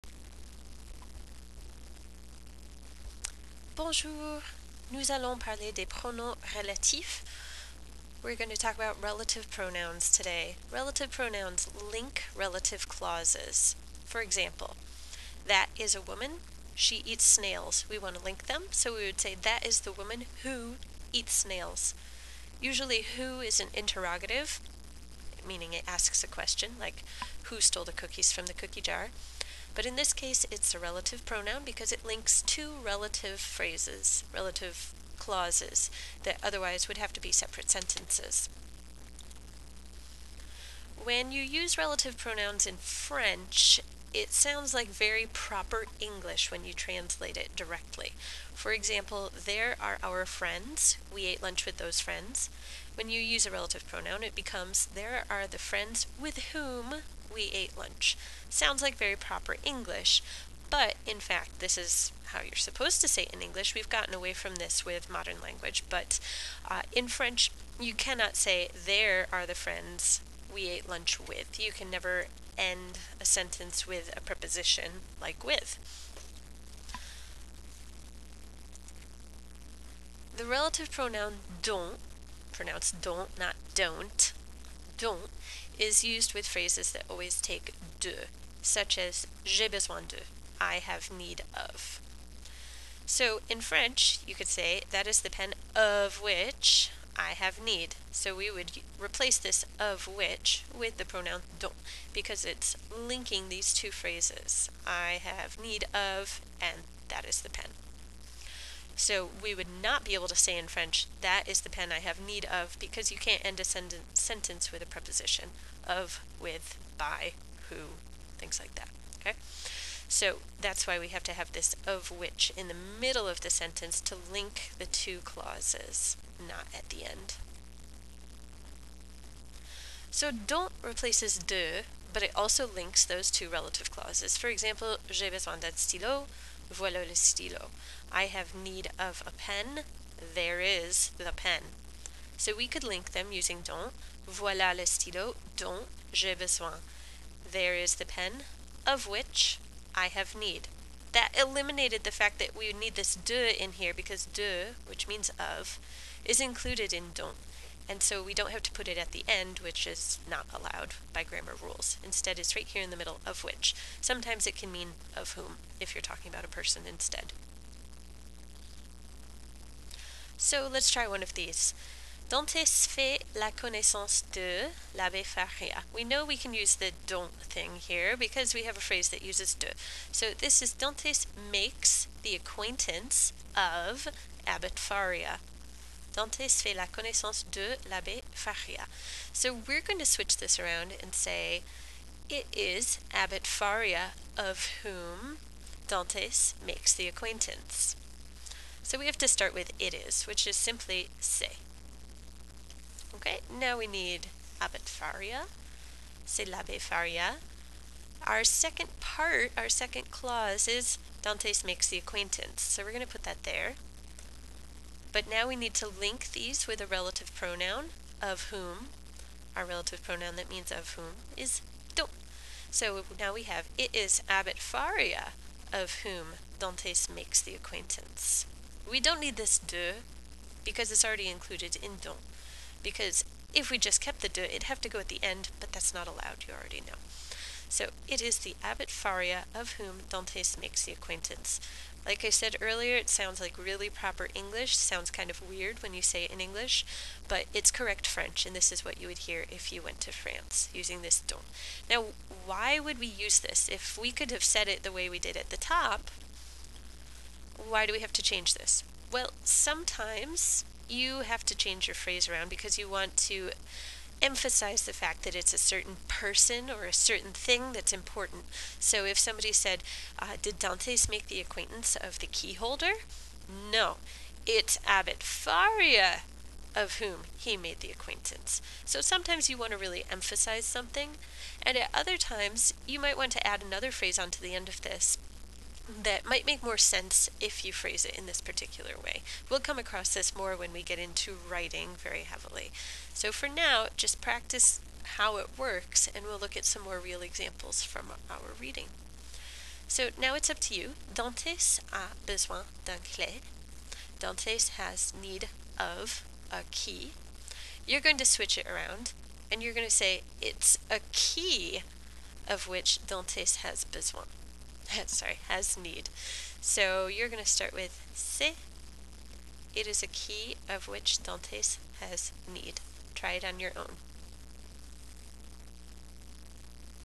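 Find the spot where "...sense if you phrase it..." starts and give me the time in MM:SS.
04:46.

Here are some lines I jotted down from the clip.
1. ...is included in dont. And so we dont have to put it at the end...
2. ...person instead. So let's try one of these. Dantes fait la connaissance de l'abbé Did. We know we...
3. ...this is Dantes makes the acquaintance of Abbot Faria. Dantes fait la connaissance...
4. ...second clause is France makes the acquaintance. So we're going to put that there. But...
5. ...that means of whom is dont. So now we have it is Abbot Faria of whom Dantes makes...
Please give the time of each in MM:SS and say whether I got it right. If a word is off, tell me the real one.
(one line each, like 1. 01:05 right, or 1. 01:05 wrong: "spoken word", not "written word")
1. 02:36 right
2. 02:46 wrong: "Faria", not "Did"
3. 03:00 right
4. 03:29 wrong: "Dantes", not "France"
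5. 03:40 right.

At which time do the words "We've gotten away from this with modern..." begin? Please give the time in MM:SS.
01:03.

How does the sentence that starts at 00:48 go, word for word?
For example, there are our friends.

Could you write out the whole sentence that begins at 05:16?
So you're going to start with C.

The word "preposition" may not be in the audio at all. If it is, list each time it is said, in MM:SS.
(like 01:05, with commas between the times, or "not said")
01:14, 01:54.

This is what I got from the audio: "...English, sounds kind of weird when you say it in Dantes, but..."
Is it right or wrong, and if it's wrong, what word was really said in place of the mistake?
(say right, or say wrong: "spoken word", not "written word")
wrong: "English", not "Dantes".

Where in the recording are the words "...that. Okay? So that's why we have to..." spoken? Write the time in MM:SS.
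01:58.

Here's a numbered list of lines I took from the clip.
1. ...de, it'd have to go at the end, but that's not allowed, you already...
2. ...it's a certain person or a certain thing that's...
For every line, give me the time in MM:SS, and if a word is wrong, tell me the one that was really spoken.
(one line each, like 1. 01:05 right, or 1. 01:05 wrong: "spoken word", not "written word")
1. 03:54 right
2. 04:25 right.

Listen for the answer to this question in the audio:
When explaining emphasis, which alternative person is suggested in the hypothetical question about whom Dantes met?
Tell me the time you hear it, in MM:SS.
04:32.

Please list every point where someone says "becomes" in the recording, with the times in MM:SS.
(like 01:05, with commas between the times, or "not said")
00:54.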